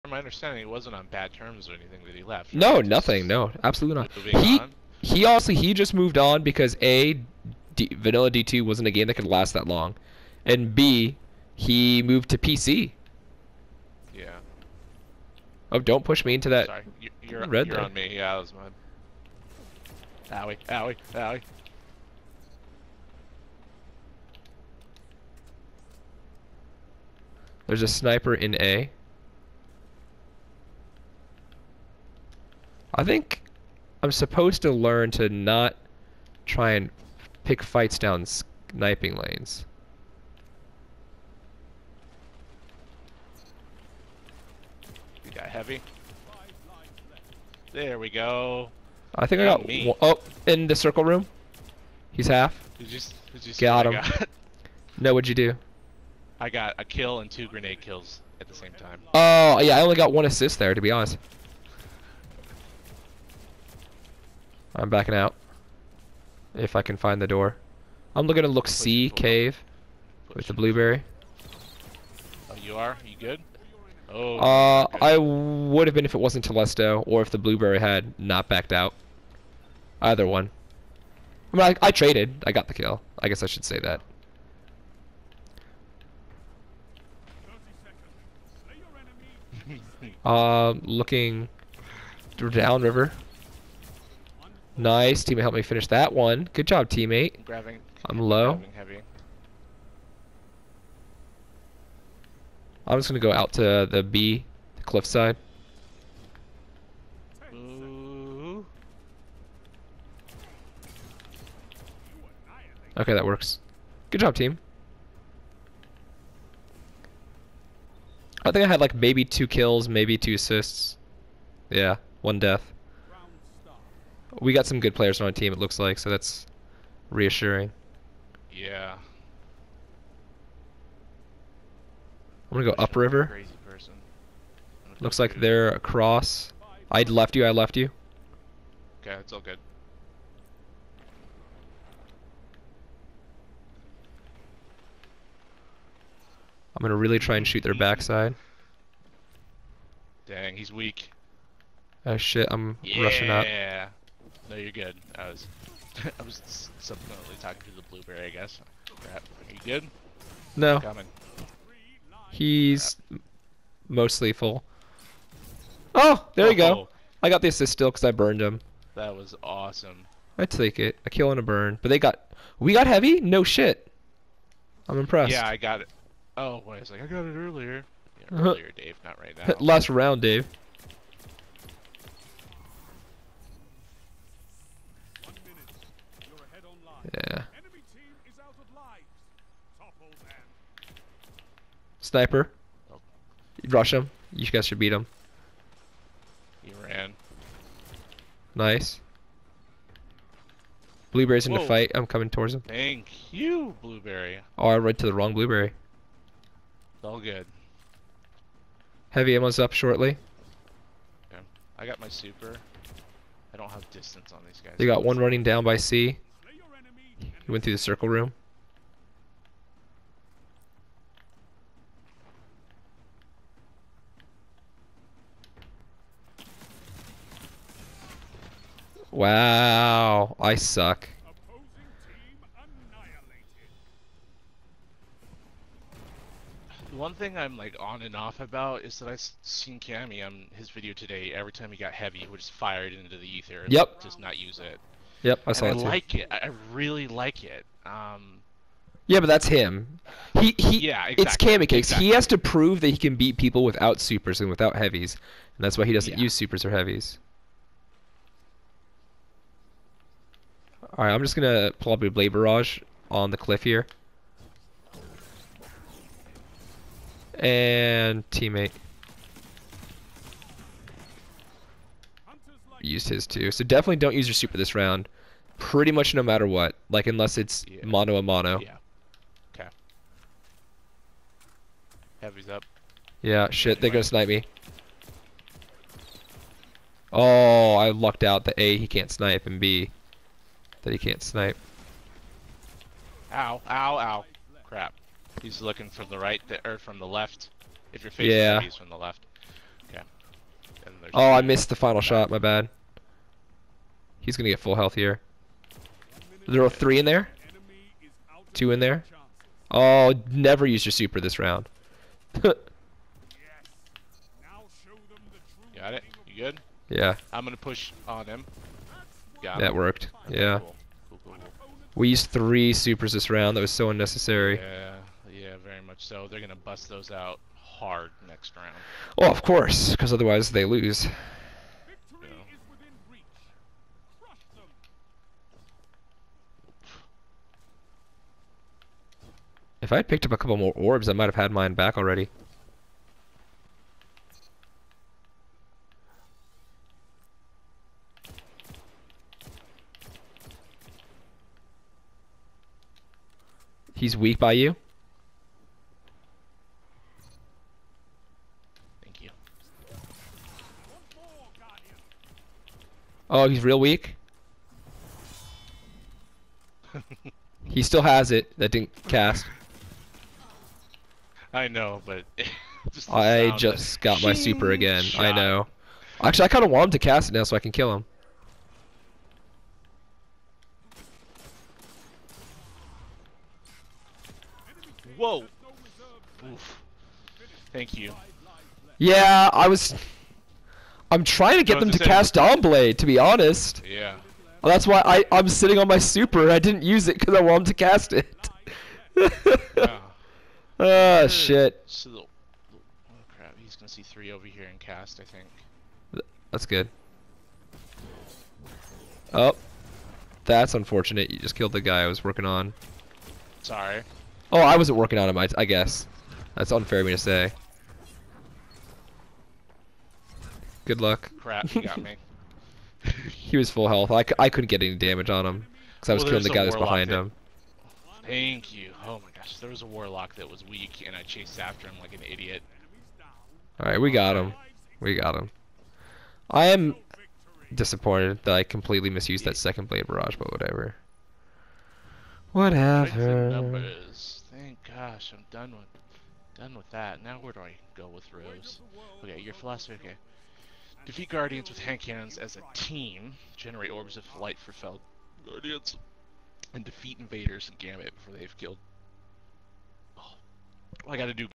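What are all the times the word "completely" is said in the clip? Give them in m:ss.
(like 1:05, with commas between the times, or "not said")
7:18.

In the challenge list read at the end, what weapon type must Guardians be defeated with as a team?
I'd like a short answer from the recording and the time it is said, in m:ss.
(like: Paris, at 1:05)
hand cannons, at 7:31.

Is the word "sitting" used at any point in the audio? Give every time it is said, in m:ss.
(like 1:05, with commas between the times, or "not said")
6:35.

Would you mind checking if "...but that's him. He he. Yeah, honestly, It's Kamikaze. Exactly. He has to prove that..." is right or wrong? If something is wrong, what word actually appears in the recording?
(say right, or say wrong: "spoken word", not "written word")
wrong: "exactly", not "honestly".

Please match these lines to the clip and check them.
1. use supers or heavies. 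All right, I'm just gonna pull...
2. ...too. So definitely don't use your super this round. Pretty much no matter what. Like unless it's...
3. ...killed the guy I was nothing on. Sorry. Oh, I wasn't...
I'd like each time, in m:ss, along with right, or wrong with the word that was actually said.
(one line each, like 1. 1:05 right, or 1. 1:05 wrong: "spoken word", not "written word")
1. 4:16 right
2. 4:33 right
3. 6:51 wrong: "working", not "nothing".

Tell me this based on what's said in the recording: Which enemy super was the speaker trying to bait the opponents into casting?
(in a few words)
Dawnblade.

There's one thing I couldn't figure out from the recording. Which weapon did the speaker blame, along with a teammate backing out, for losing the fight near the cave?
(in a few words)
Telesto.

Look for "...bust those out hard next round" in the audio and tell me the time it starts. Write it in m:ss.
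5:26.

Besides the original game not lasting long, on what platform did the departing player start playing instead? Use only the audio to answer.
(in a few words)
PC.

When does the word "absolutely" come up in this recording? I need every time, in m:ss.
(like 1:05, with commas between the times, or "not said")
0:03.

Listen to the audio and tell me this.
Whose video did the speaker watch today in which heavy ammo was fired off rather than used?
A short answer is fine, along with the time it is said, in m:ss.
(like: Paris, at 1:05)
Cammy, at 3:59.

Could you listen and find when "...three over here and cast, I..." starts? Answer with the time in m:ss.
6:44.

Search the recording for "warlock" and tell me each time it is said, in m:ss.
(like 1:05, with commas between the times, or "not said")
7:09.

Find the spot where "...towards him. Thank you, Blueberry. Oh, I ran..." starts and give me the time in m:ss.
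3:22.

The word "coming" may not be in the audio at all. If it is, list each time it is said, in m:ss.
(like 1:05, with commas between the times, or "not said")
2:40, 3:22.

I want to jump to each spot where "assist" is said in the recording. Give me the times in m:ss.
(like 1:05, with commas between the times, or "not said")
1:00, 2:00, 2:47.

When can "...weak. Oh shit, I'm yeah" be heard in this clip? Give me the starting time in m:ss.
2:30.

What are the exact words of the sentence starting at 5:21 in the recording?
Cool, cool, we used three supers this round.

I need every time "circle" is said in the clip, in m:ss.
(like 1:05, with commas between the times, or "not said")
0:50, 3:37.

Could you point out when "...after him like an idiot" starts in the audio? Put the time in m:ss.
7:11.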